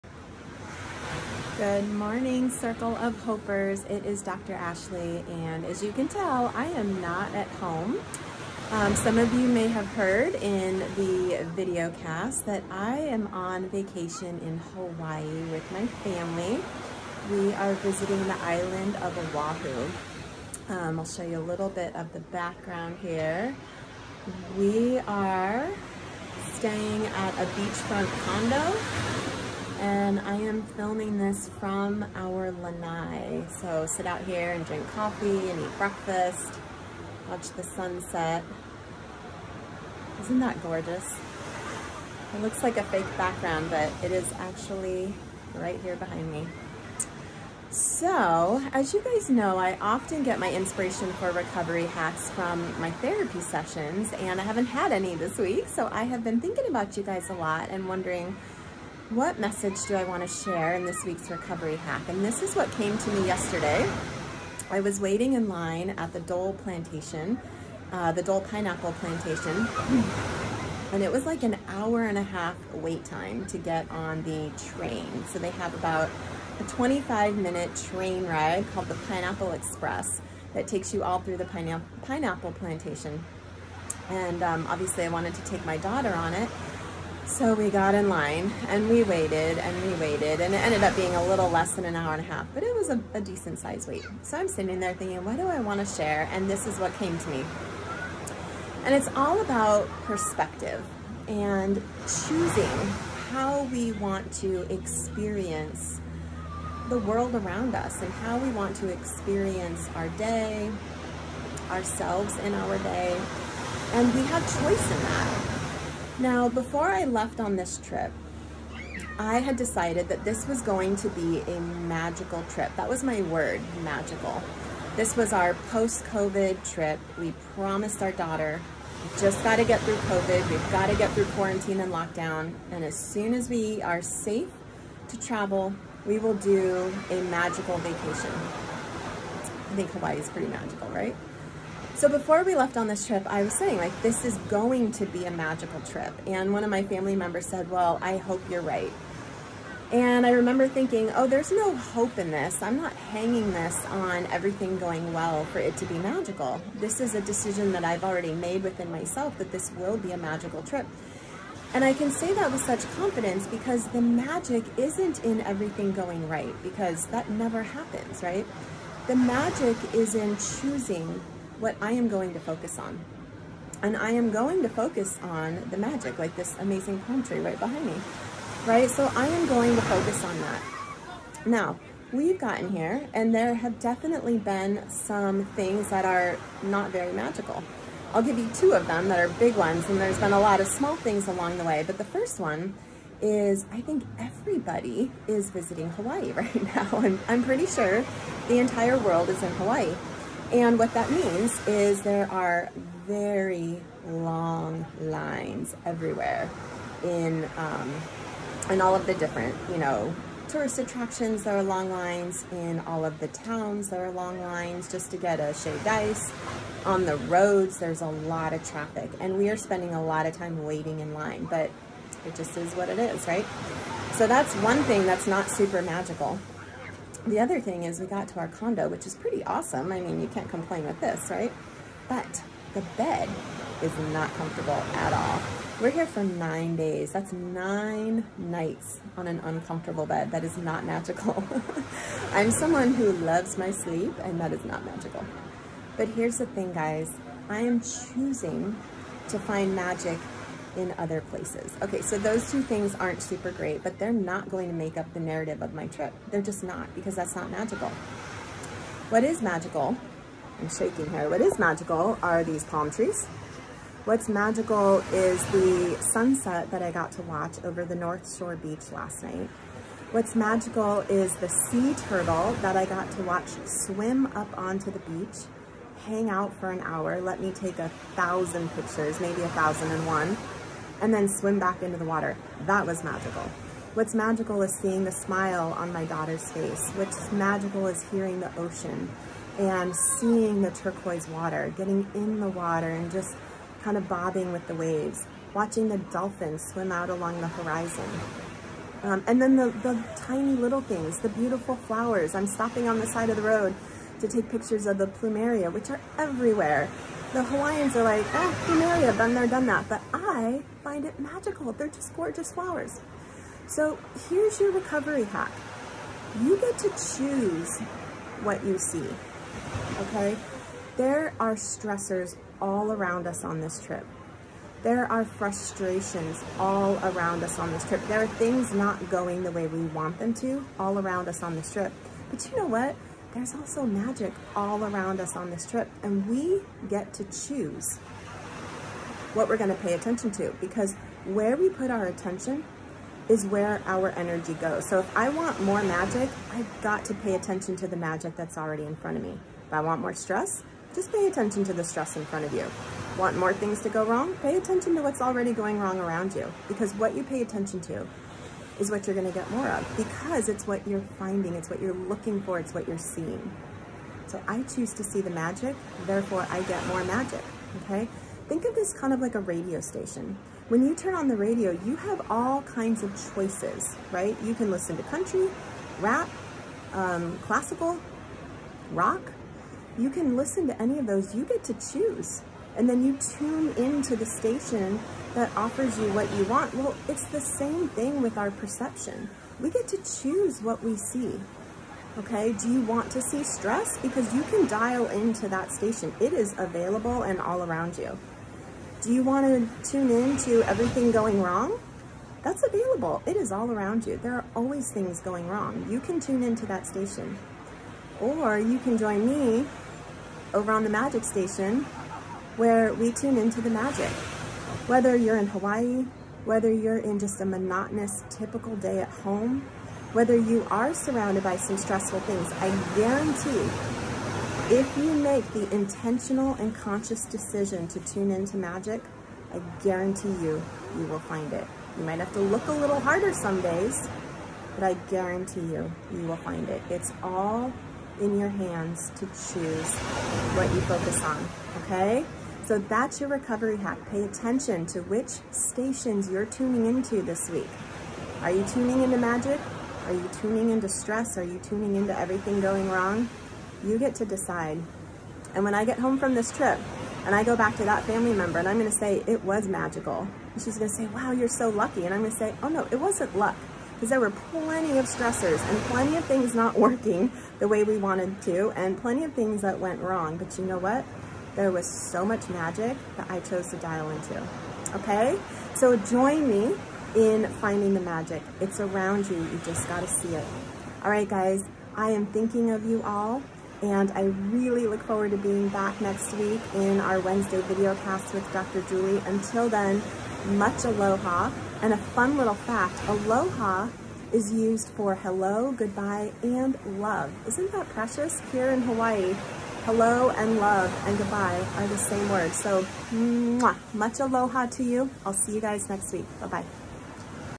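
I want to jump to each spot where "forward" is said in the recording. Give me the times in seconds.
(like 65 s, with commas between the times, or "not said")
485 s.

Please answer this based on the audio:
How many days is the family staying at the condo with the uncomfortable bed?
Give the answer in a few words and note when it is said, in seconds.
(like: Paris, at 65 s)
9, at 236 s.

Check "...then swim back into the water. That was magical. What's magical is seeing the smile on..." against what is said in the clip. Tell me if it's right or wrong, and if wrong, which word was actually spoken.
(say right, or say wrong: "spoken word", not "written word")
right.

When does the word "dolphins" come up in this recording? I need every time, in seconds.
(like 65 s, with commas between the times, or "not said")
295 s.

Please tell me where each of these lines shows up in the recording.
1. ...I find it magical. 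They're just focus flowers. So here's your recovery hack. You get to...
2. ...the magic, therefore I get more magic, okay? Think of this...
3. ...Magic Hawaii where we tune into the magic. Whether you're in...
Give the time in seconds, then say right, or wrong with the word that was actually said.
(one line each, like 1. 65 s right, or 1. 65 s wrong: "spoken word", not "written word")
1. 310 s wrong: "gorgeous", not "focus"
2. 365 s right
3. 410 s wrong: "Station", not "Hawaii".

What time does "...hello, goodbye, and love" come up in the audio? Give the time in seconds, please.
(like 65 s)
495 s.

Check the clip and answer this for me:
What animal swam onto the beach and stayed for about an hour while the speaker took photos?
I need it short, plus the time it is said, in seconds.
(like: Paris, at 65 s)
sea turtle, at 271 s.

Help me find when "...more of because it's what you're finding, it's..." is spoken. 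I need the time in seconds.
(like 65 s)
359 s.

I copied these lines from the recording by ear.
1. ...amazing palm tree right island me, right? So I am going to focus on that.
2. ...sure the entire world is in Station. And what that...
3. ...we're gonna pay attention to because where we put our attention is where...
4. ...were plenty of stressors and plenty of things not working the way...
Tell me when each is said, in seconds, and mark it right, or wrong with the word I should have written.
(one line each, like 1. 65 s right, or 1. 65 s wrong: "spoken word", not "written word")
1. 176 s wrong: "behind", not "island"
2. 197 s wrong: "Hawaii", not "Station"
3. 339 s right
4. 464 s right.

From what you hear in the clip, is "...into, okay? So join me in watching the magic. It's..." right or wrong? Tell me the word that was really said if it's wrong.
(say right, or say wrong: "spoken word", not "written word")
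wrong: "finding", not "watching".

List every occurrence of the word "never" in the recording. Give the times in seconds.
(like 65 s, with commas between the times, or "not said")
167 s.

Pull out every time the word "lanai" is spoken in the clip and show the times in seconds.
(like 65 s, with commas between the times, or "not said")
32 s.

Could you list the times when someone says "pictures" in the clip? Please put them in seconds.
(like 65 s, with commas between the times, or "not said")
278 s, 304 s.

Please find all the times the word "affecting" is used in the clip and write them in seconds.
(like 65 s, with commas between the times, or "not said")
not said.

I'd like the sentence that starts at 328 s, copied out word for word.
There are things not going the way we want them to all around us on this trip.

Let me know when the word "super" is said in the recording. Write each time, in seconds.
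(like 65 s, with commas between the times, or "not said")
225 s, 253 s.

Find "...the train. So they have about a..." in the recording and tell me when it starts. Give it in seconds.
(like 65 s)
74 s.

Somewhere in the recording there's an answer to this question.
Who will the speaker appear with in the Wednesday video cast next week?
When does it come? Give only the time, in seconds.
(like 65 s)
488 s.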